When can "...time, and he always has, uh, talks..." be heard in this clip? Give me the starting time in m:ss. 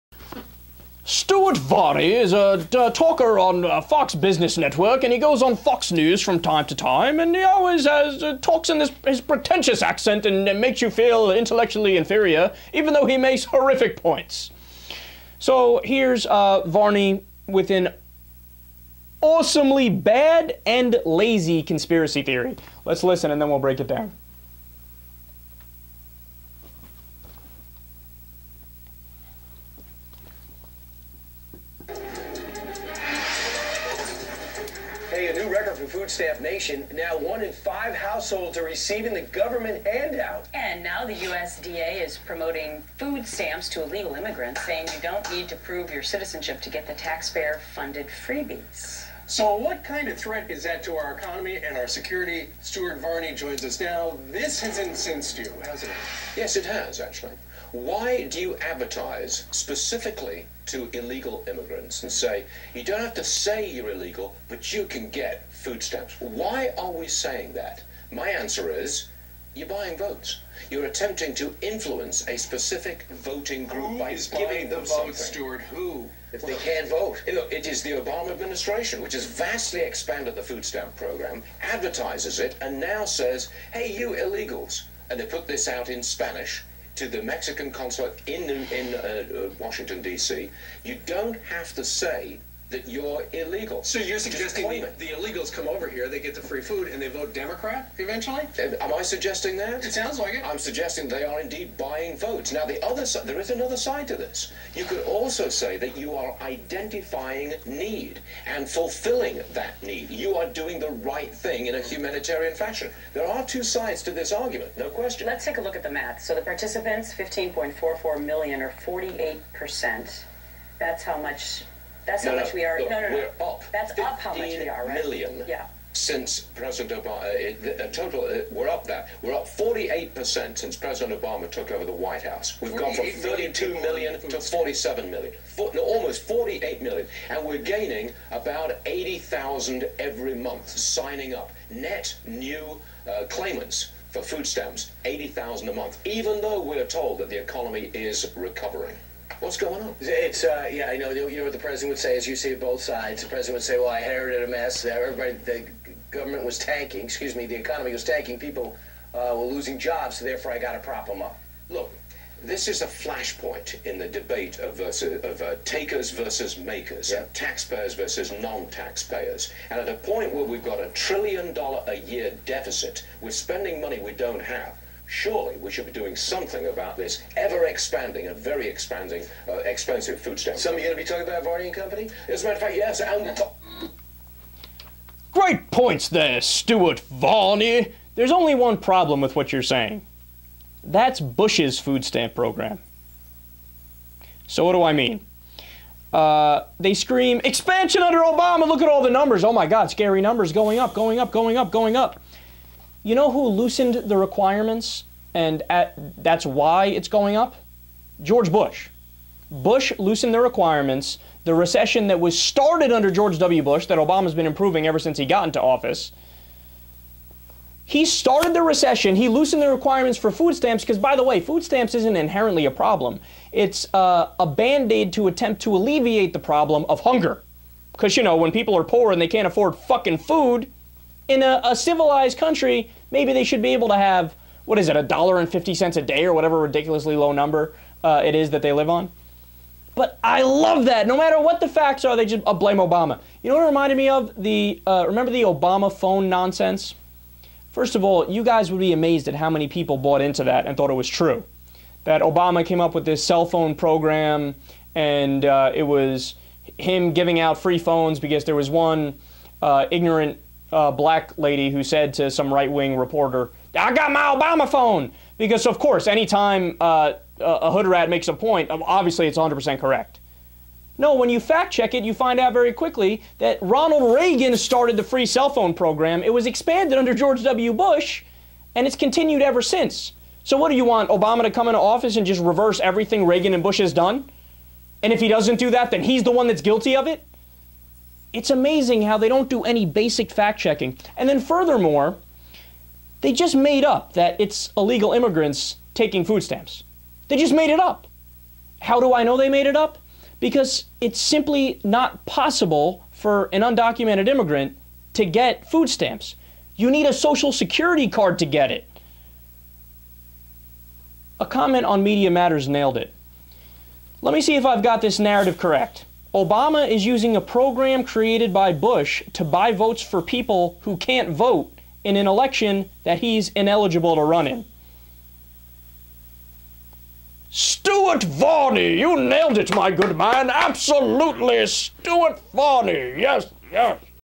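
0:06.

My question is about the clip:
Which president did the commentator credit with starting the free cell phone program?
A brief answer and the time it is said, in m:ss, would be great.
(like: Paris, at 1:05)
Ronald Reagan, at 4:33.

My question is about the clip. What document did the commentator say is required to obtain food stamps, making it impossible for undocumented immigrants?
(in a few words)
social security card.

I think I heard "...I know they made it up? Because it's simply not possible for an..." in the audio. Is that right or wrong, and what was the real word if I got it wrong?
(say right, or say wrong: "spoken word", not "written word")
right.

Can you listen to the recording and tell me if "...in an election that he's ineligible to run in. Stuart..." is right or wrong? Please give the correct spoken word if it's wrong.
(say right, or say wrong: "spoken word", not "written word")
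right.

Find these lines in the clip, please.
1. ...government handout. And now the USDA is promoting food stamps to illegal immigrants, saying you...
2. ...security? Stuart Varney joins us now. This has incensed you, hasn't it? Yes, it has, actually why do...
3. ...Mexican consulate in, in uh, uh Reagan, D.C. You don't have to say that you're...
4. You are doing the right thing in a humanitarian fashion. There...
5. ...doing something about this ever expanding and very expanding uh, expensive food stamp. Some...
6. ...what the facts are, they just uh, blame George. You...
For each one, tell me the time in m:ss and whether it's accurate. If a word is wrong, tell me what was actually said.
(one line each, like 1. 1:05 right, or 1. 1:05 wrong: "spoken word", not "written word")
1. 0:39 right
2. 0:51 right
3. 1:27 wrong: "Washington", not "Reagan"
4. 1:50 right
5. 2:55 right
6. 4:01 wrong: "Obama", not "George".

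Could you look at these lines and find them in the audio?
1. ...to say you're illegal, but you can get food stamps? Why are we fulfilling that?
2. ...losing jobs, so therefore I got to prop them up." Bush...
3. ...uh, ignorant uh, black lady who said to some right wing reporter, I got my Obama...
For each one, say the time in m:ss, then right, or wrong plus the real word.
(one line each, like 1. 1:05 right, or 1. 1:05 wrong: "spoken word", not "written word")
1. 1:03 wrong: "saying", not "fulfilling"
2. 2:39 wrong: "Look", not "Bush"
3. 4:19 right.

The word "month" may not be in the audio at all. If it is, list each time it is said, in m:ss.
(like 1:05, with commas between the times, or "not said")
2:20, 2:25.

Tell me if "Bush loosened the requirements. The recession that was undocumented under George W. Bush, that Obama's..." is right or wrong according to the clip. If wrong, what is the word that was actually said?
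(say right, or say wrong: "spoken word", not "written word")
wrong: "started", not "undocumented".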